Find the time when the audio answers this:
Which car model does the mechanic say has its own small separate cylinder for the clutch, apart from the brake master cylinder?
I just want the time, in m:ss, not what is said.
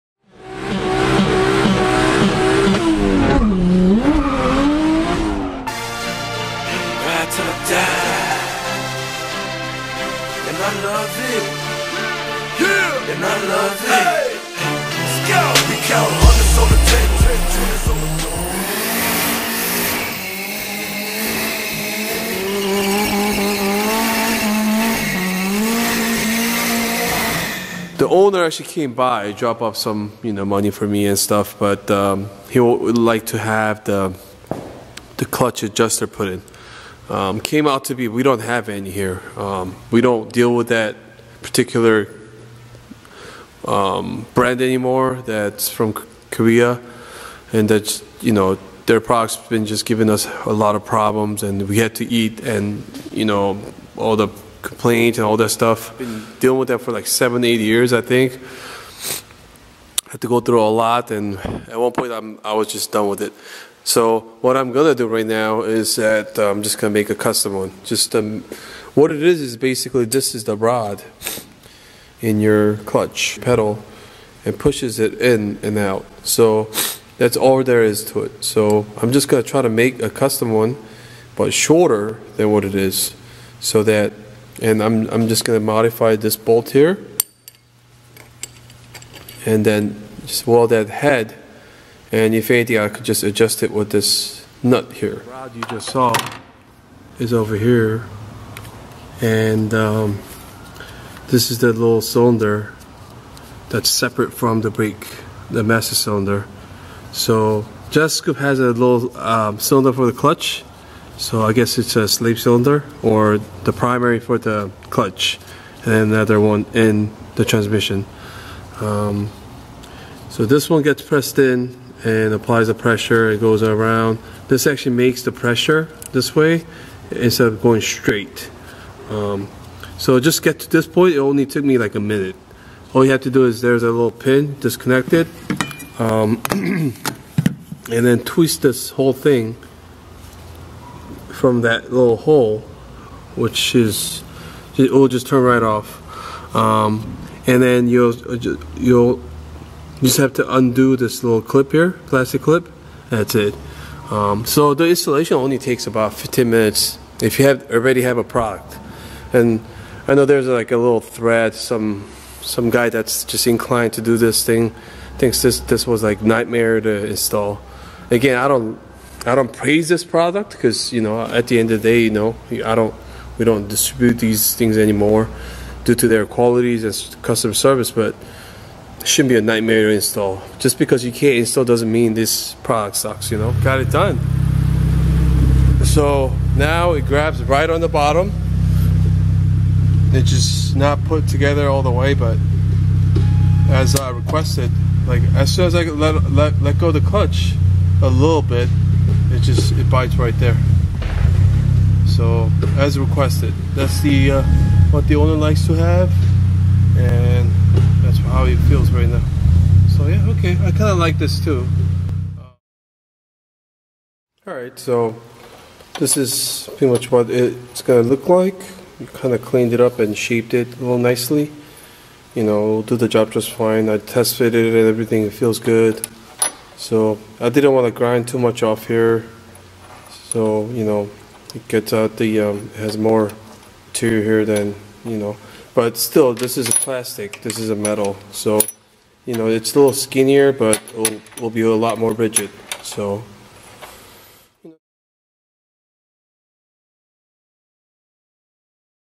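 1:47.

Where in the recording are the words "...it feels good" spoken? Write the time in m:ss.
3:45.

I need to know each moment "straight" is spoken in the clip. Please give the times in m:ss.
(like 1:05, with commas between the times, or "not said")
2:07.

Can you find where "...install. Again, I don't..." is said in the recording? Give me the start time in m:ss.
2:47.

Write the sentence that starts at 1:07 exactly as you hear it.
Just um, what it is is basically this is the rod in your clutch pedal and pushes it in and out.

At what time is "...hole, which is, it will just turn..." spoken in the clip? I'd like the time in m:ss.
2:22.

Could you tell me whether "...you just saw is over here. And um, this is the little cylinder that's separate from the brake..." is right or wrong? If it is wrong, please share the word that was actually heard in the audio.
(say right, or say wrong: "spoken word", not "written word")
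right.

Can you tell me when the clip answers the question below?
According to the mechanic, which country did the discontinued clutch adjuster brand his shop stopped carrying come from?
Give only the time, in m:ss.
0:46.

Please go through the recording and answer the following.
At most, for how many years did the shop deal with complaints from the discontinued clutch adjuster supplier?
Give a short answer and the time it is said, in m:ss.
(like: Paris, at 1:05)
8, at 0:57.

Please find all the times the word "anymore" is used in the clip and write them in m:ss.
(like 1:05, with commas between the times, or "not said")
0:44, 2:54.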